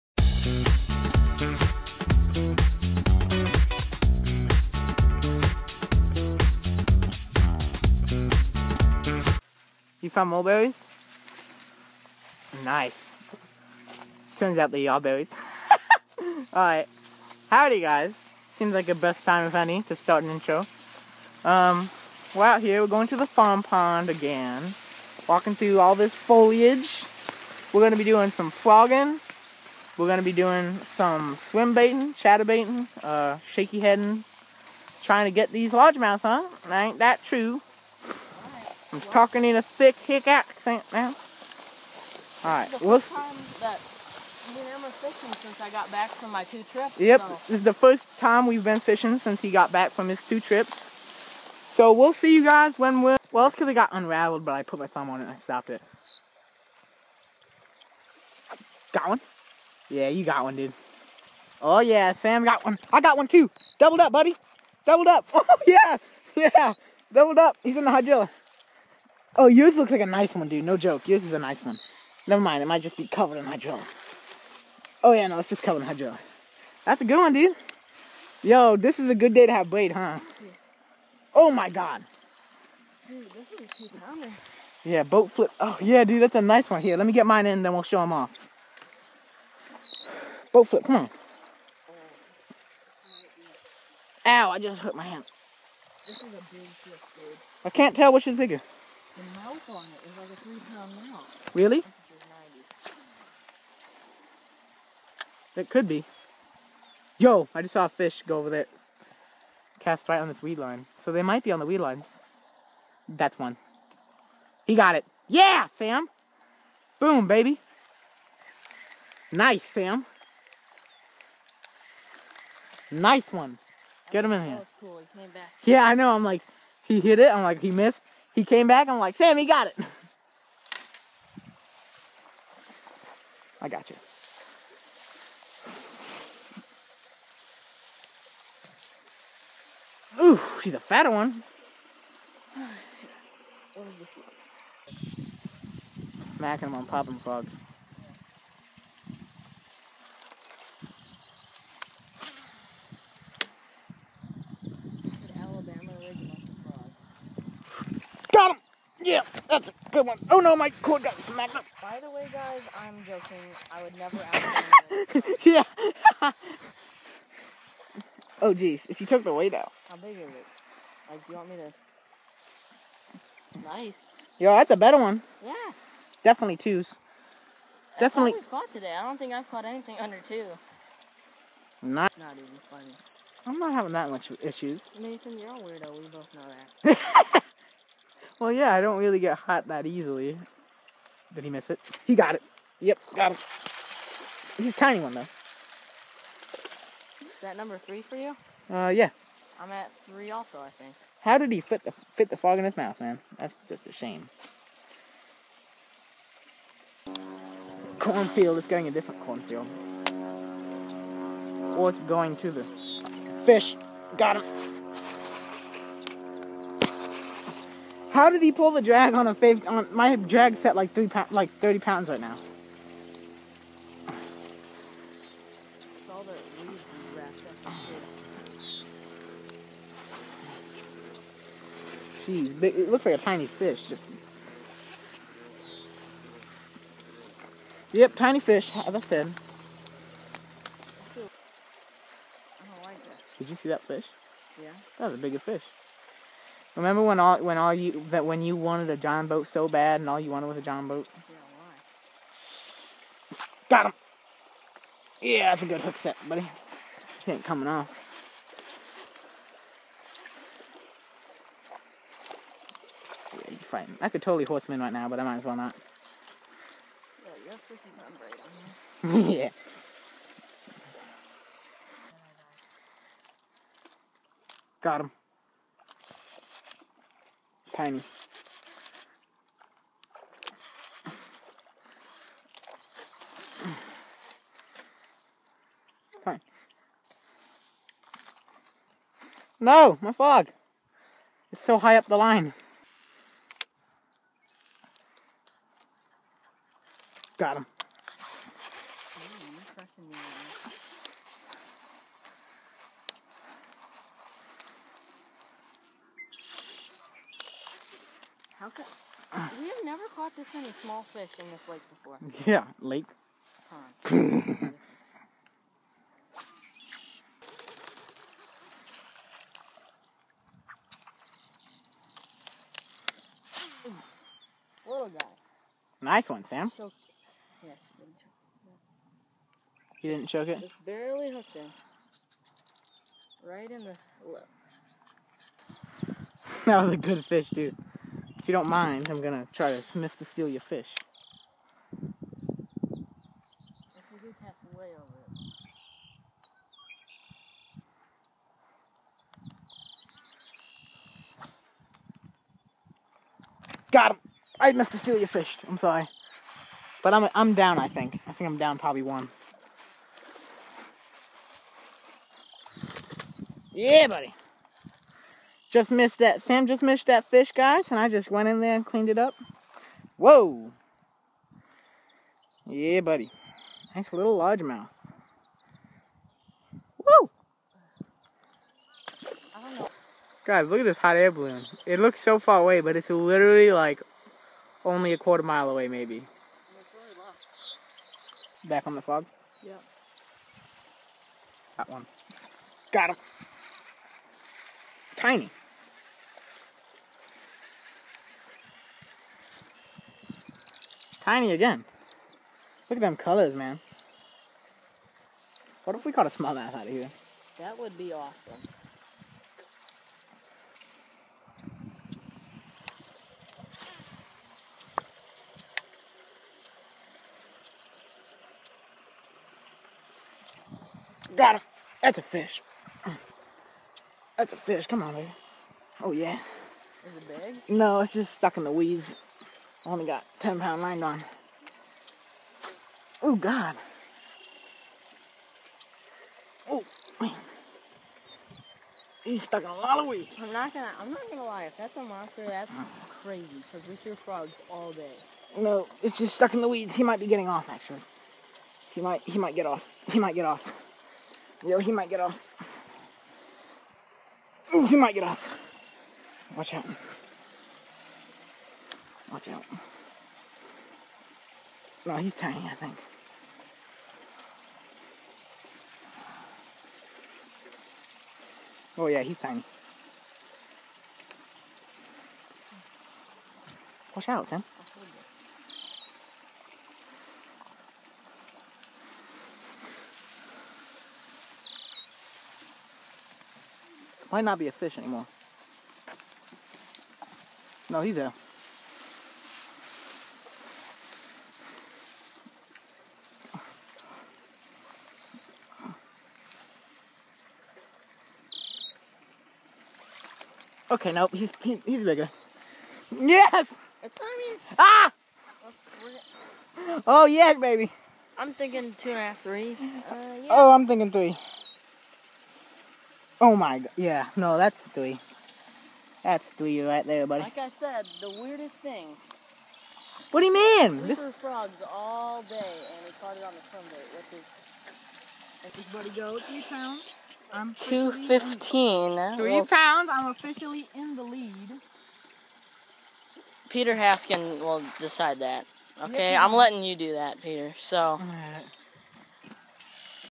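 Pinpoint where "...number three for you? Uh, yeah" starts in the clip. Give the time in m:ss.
3:17.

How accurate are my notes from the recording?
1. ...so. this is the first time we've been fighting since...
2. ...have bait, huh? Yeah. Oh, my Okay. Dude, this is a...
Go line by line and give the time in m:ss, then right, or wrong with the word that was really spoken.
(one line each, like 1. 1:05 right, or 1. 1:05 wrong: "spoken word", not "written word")
1. 0:47 wrong: "fishing", not "fighting"
2. 1:19 wrong: "God", not "Okay".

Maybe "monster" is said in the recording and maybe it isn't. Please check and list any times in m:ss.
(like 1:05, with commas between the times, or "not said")
7:22.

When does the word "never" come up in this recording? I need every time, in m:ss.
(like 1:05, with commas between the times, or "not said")
1:12, 2:43, 5:09.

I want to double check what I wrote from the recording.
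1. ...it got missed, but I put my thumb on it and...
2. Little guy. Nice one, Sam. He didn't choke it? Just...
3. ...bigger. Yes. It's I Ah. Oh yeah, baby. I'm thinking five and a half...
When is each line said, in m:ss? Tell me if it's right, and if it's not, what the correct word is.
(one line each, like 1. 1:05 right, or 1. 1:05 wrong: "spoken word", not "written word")
1. 0:53 wrong: "unraveled", not "missed"
2. 5:24 right
3. 8:22 wrong: "two", not "five".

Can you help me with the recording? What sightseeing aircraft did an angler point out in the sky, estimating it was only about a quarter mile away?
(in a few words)
Hot air balloon.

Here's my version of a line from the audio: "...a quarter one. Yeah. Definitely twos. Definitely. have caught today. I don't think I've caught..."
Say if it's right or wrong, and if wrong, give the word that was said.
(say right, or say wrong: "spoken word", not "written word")
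wrong: "better", not "quarter".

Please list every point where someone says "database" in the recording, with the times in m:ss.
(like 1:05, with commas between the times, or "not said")
not said.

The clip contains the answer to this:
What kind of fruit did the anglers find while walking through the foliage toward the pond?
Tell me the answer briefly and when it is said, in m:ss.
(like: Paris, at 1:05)
Mulberries, at 0:10.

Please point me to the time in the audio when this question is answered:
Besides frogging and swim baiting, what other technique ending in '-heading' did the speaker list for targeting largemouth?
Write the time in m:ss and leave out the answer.
0:33.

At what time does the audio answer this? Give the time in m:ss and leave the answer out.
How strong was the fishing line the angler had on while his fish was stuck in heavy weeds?
7:10.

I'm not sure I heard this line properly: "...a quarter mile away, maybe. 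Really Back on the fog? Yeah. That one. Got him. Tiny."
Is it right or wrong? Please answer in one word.
right.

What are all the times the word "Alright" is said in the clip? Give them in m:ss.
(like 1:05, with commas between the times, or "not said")
0:16, 0:42.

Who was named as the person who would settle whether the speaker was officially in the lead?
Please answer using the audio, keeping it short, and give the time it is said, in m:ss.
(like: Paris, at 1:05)
Peter Haskin, at 8:53.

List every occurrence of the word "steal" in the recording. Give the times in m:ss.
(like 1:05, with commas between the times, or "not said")
5:40, 5:54.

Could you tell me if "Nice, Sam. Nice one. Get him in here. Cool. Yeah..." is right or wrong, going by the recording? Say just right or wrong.
right.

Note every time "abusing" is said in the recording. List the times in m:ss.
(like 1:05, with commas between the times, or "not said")
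not said.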